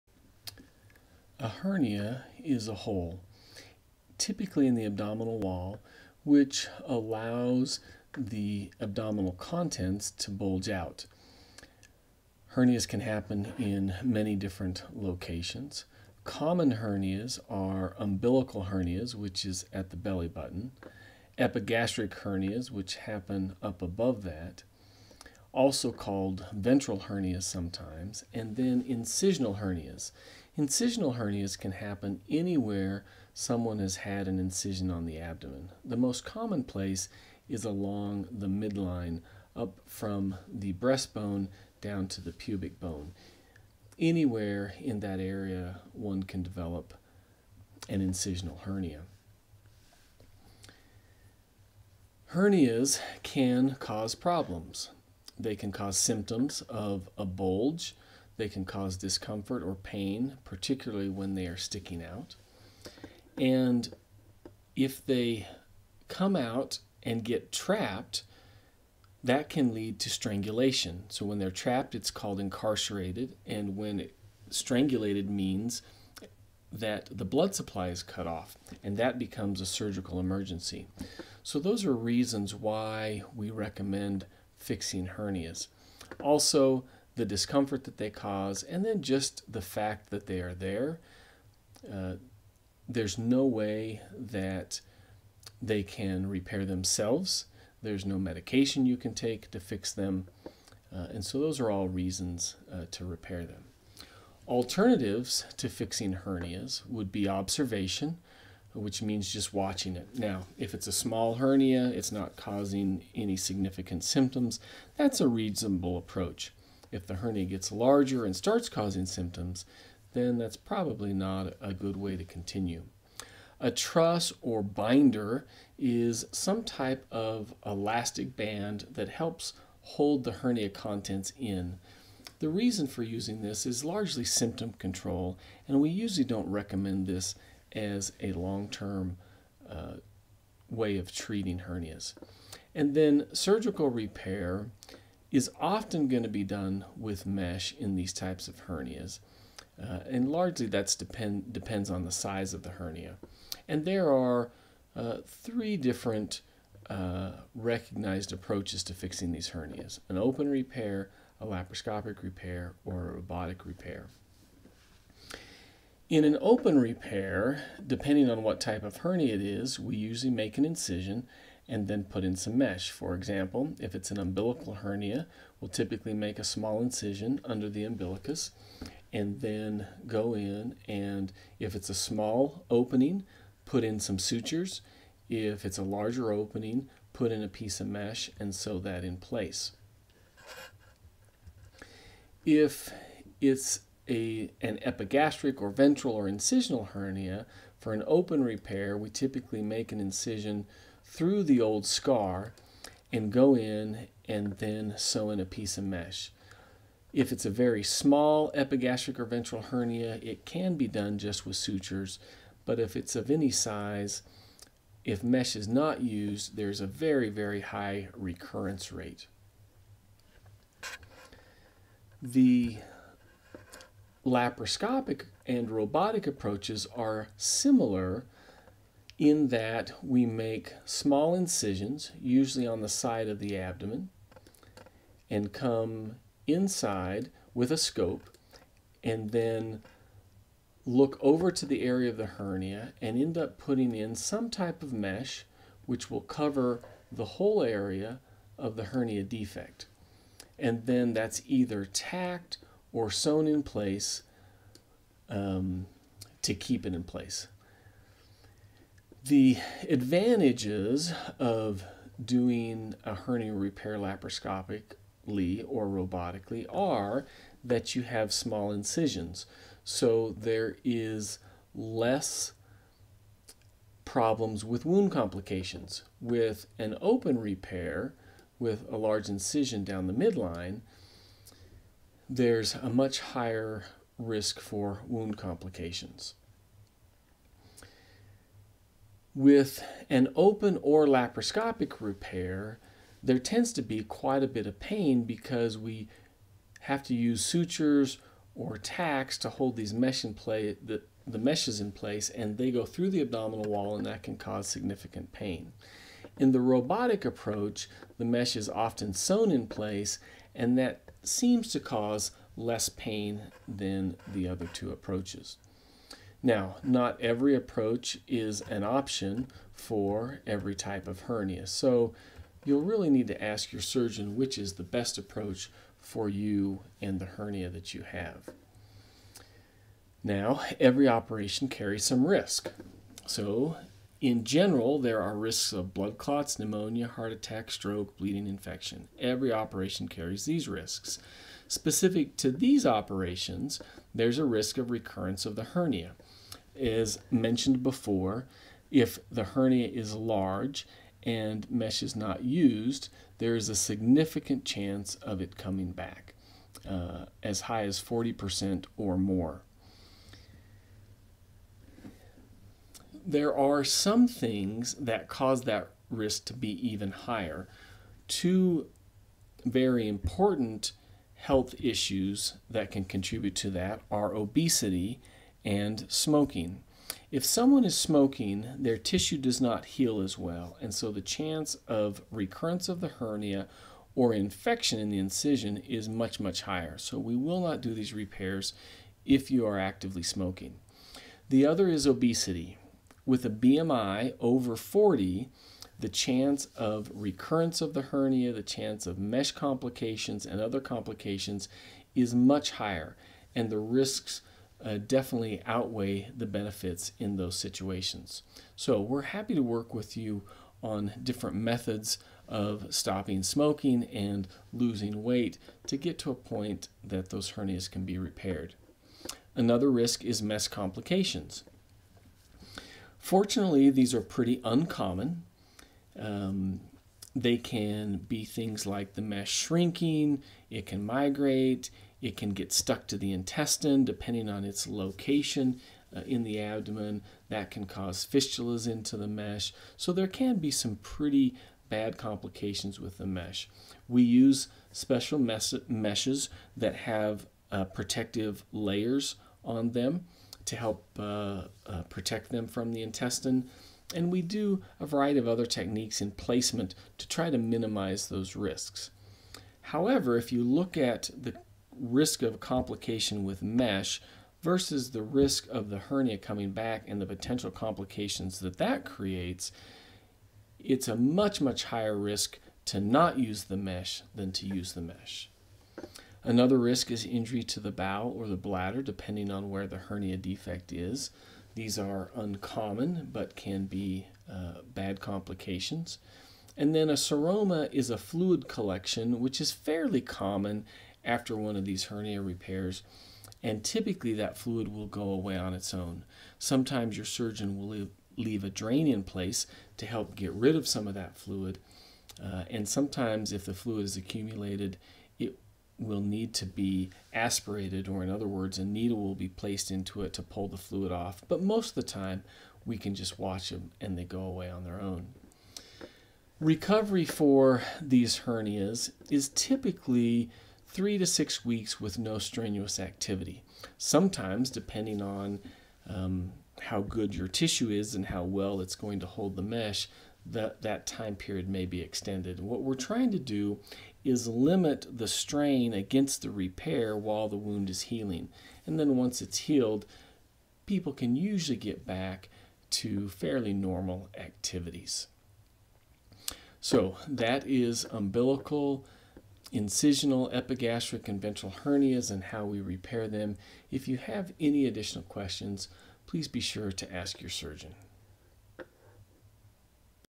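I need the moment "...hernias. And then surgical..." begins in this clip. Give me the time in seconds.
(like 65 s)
141 s.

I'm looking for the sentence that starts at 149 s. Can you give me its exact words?
Uh, and largely that's depend, depends on the size of the hernia.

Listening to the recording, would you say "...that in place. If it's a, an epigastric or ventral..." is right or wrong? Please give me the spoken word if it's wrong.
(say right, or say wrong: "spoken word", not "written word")
right.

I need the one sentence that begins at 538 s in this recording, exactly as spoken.
And then once it's healed, people can usually get back to fairly normal activities.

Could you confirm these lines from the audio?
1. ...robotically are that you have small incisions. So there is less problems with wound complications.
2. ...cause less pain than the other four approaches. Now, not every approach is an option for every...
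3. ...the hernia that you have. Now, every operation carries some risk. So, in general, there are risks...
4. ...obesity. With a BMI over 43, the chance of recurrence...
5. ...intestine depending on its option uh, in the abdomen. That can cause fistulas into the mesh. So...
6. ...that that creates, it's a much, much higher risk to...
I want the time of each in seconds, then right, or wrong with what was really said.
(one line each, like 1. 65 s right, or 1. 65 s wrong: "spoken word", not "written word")
1. 265 s right
2. 311 s wrong: "two", not "four"
3. 327 s right
4. 392 s wrong: "40", not "43"
5. 433 s wrong: "location", not "option"
6. 468 s right.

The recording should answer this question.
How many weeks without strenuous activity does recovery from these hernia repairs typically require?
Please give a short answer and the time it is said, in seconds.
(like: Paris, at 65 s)
3 to 6 weeks, at 520 s.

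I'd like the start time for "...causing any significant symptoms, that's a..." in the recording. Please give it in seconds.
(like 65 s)
112 s.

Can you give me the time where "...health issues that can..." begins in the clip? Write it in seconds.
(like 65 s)
371 s.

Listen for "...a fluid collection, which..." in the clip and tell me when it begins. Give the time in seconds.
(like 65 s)
488 s.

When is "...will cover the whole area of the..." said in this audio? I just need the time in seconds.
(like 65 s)
246 s.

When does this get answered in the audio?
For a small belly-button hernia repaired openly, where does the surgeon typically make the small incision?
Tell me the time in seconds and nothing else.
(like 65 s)
177 s.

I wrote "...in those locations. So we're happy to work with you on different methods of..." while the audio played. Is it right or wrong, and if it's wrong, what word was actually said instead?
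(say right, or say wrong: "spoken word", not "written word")
wrong: "situations", not "locations".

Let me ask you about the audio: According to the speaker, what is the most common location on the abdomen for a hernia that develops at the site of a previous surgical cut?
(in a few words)
Along the midline.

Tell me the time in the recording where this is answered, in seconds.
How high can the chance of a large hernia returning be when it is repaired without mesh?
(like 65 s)
358 s.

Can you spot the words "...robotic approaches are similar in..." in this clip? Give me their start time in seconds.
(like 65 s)
225 s.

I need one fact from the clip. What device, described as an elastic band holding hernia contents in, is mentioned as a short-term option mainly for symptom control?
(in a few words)
Truss or binder.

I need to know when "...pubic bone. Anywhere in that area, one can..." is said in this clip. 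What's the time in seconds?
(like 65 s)
42 s.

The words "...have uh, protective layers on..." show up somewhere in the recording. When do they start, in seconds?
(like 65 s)
446 s.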